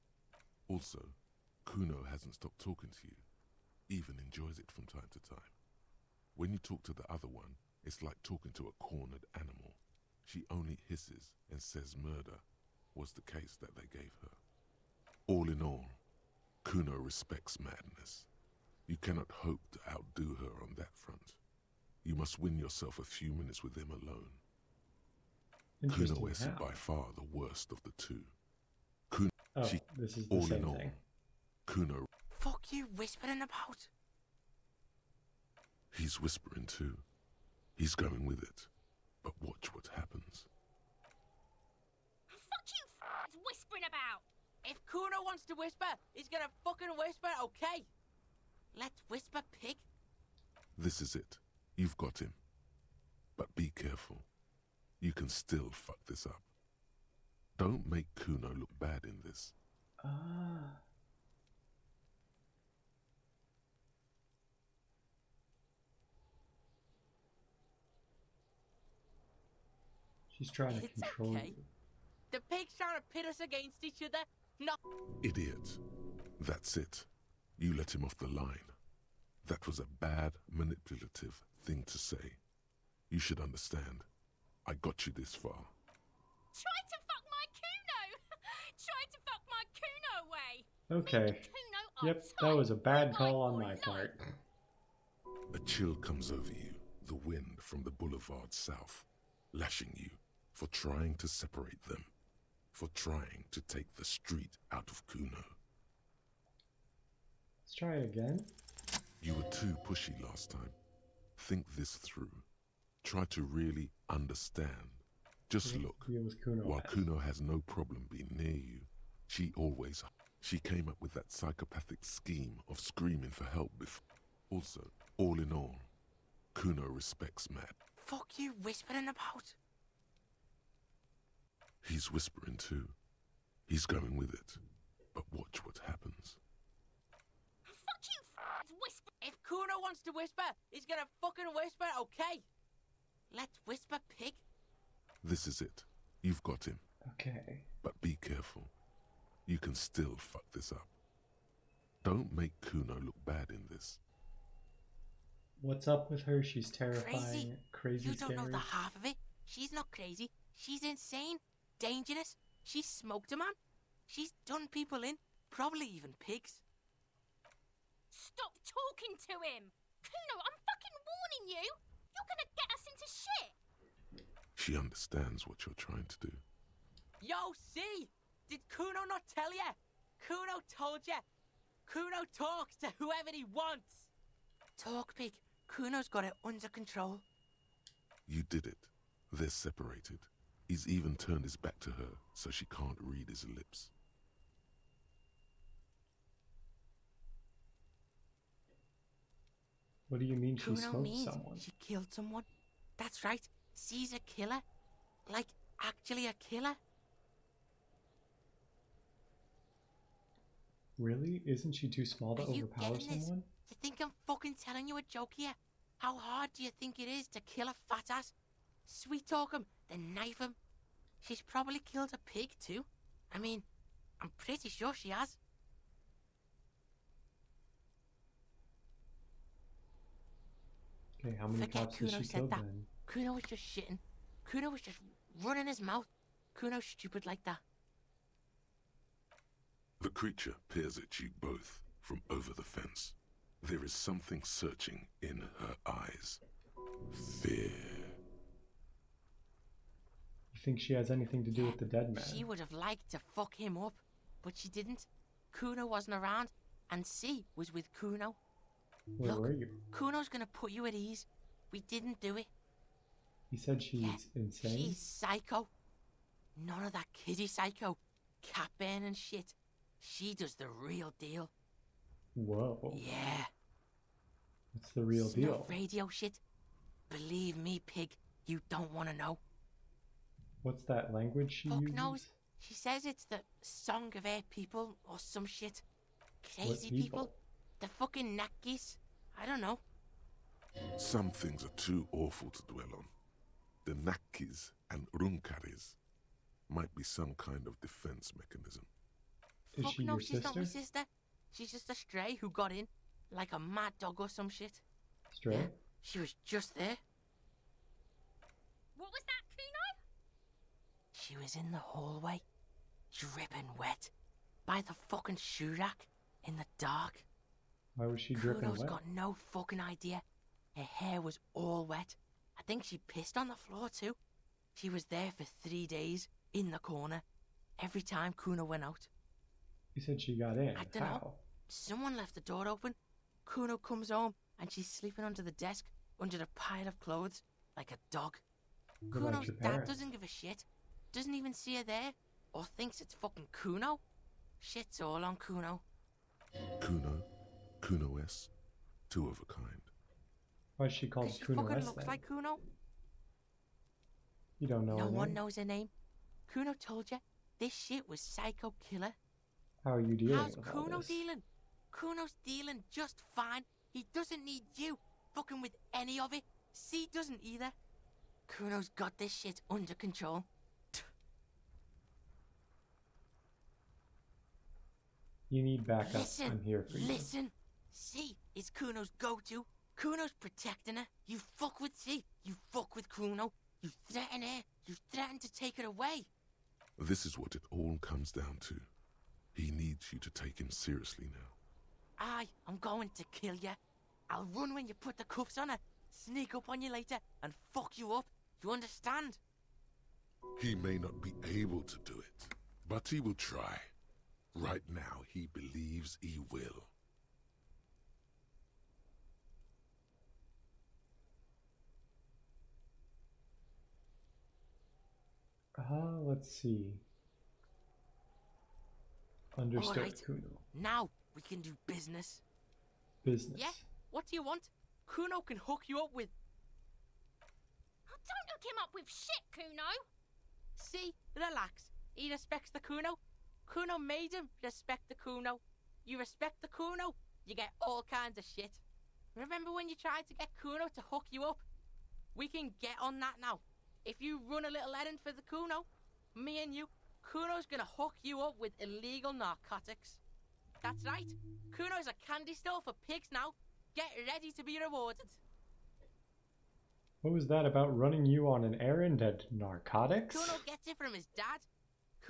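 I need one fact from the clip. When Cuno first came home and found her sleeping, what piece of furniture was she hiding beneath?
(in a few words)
The desk.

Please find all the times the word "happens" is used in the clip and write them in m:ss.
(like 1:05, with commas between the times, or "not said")
0:39, 2:15.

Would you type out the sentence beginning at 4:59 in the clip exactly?
Is Fuck she no, your she's sister?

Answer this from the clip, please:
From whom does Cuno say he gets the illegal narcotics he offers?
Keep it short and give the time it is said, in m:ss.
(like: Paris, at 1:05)
His dad, at 7:41.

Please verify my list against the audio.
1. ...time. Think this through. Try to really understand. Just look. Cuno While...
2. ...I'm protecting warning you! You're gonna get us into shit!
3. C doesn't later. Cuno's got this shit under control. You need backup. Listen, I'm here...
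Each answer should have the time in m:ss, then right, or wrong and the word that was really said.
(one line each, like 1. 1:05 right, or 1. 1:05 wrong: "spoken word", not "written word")
1. 1:50 right
2. 2:50 wrong: "fucking", not "protecting"
3. 6:06 wrong: "either", not "later".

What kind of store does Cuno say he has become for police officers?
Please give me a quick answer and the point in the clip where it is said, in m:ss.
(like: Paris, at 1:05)
A candy store, at 7:32.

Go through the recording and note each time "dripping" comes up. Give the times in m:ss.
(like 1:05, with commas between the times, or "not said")
5:13, 5:18.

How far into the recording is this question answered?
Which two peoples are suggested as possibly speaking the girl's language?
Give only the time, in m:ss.
4:53.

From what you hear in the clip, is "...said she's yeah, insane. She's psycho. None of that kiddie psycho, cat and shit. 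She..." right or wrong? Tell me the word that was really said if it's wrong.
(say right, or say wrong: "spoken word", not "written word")
right.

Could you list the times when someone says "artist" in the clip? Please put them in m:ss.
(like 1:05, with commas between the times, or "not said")
not said.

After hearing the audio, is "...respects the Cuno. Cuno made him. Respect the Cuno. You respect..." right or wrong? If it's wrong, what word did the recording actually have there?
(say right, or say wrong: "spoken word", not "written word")
right.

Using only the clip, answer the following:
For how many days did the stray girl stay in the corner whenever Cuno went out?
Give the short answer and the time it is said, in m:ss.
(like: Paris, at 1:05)
3, at 5:25.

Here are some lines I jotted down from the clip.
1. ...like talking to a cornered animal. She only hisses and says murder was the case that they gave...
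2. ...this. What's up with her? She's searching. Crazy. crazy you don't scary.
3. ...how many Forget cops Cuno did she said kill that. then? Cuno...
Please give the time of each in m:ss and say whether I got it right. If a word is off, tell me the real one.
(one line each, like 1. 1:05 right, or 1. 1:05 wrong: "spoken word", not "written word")
1. 0:08 right
2. 2:33 wrong: "terrifying", not "searching"
3. 3:51 right.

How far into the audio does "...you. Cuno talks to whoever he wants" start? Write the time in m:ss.
3:01.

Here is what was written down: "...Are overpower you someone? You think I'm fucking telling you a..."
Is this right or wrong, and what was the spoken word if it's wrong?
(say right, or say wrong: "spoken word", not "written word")
right.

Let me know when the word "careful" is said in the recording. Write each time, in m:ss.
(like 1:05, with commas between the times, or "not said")
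0:53, 2:28.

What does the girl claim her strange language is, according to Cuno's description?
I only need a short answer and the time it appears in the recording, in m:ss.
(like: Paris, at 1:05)
Song of Air people, at 4:43.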